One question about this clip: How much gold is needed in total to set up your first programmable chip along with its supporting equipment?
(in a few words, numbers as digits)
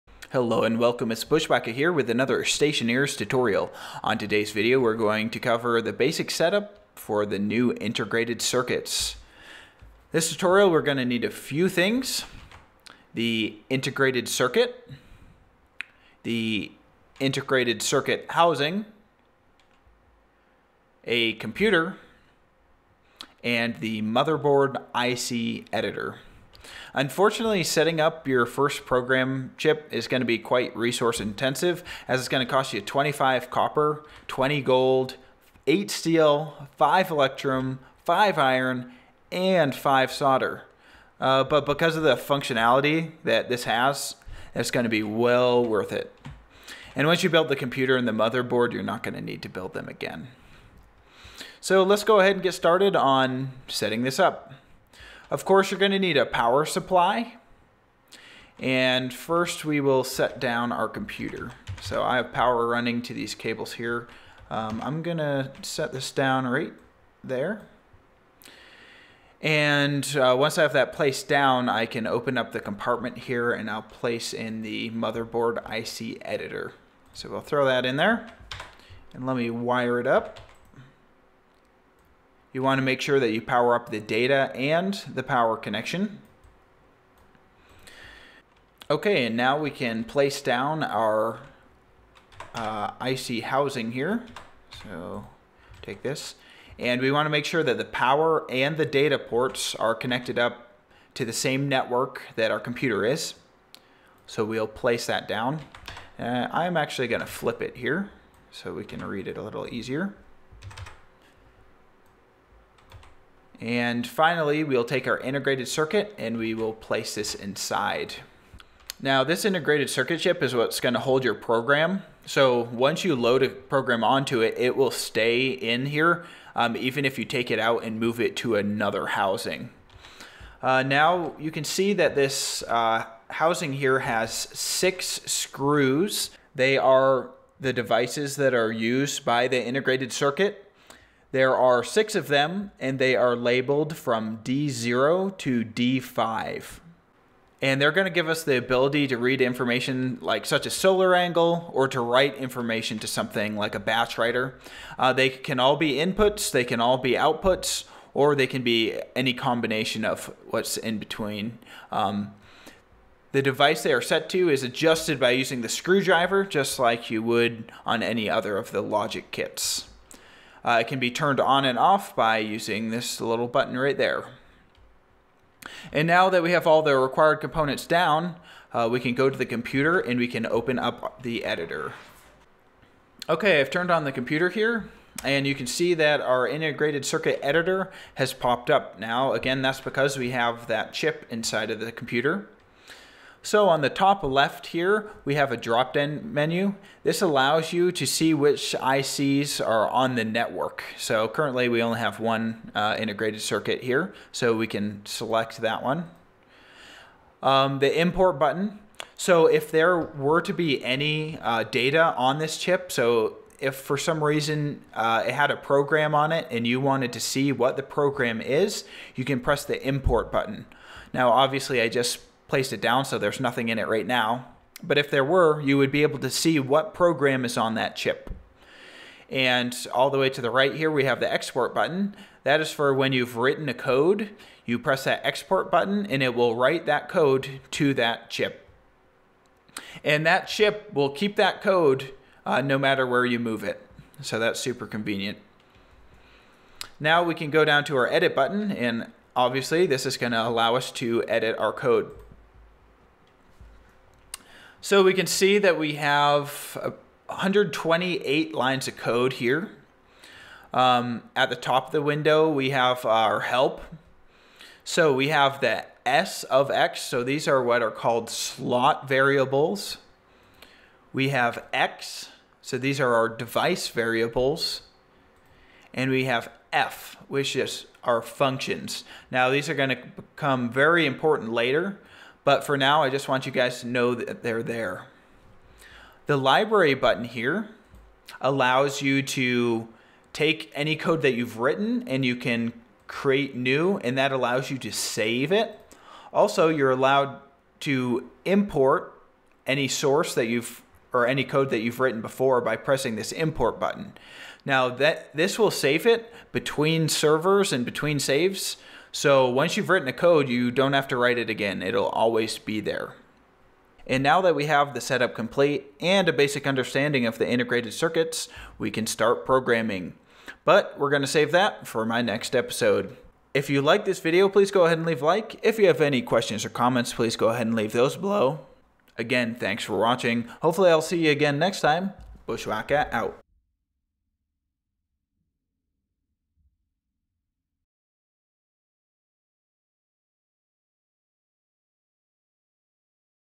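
20.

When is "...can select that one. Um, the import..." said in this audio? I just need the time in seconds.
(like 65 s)
204 s.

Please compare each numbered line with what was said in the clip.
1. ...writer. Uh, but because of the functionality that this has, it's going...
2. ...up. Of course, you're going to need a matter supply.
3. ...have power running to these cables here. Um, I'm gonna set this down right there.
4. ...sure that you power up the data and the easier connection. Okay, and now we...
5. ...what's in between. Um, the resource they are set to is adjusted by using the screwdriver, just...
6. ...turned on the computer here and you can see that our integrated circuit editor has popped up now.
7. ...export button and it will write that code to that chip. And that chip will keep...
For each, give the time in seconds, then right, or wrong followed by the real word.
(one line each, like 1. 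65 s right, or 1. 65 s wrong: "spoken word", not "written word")
1. 40 s wrong: "solder", not "writer"
2. 54 s wrong: "power", not "matter"
3. 62 s right
4. 82 s wrong: "power", not "easier"
5. 160 s wrong: "device", not "resource"
6. 183 s right
7. 235 s right.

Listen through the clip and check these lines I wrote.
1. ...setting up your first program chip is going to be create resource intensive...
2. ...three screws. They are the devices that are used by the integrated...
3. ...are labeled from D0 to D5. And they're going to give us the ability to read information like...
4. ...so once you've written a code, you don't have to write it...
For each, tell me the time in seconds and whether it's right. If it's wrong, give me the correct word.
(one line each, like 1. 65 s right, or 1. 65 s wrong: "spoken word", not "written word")
1. 27 s wrong: "quite", not "create"
2. 134 s wrong: "six", not "three"
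3. 143 s right
4. 309 s right.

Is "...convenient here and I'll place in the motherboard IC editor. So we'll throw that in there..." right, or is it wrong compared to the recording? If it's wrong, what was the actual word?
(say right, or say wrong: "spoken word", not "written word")
wrong: "compartment", not "convenient".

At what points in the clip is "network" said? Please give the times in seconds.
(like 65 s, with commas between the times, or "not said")
101 s, 200 s.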